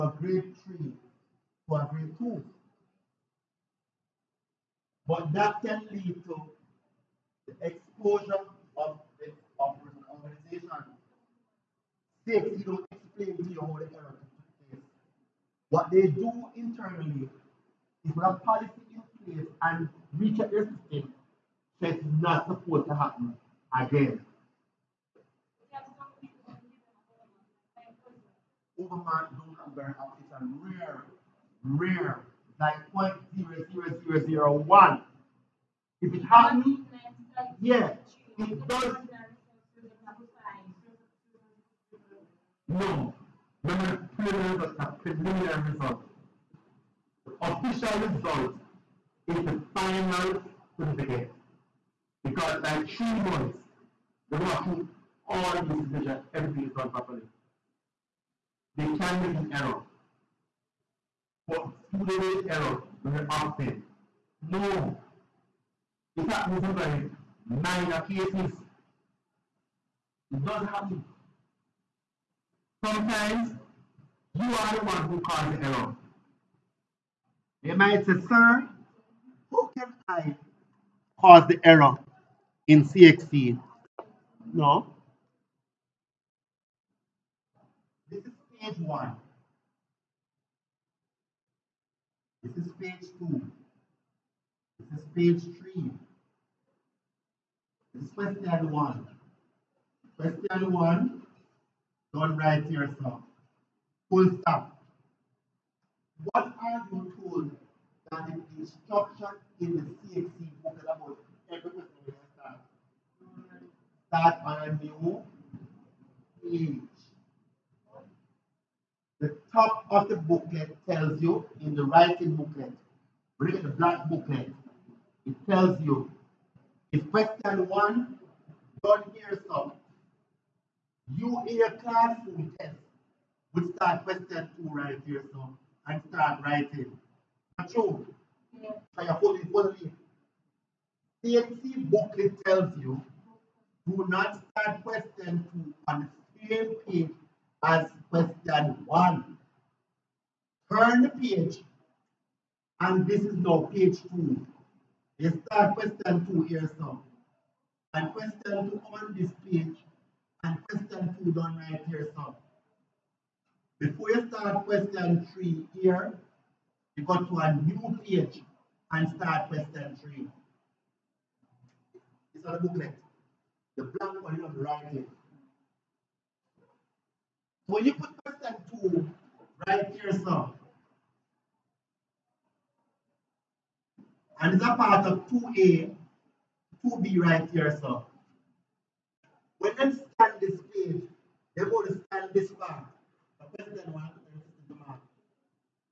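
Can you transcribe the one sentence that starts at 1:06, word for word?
It happens in some very minor cases.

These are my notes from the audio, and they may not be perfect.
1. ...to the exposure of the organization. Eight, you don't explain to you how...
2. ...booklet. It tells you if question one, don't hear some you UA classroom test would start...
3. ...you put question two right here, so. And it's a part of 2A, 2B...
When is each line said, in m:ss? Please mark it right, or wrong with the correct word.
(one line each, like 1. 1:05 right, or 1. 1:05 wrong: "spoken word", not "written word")
1. 0:06 wrong: "Six", not "Eight"
2. 2:04 right
3. 2:57 right.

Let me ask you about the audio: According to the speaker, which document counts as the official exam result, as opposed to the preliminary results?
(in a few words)
final certificate.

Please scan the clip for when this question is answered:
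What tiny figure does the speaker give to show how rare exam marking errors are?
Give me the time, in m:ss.
0:33.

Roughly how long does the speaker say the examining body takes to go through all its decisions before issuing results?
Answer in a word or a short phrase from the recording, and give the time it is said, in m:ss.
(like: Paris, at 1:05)
3 months, at 0:52.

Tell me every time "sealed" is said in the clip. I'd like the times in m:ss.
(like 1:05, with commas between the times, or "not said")
not said.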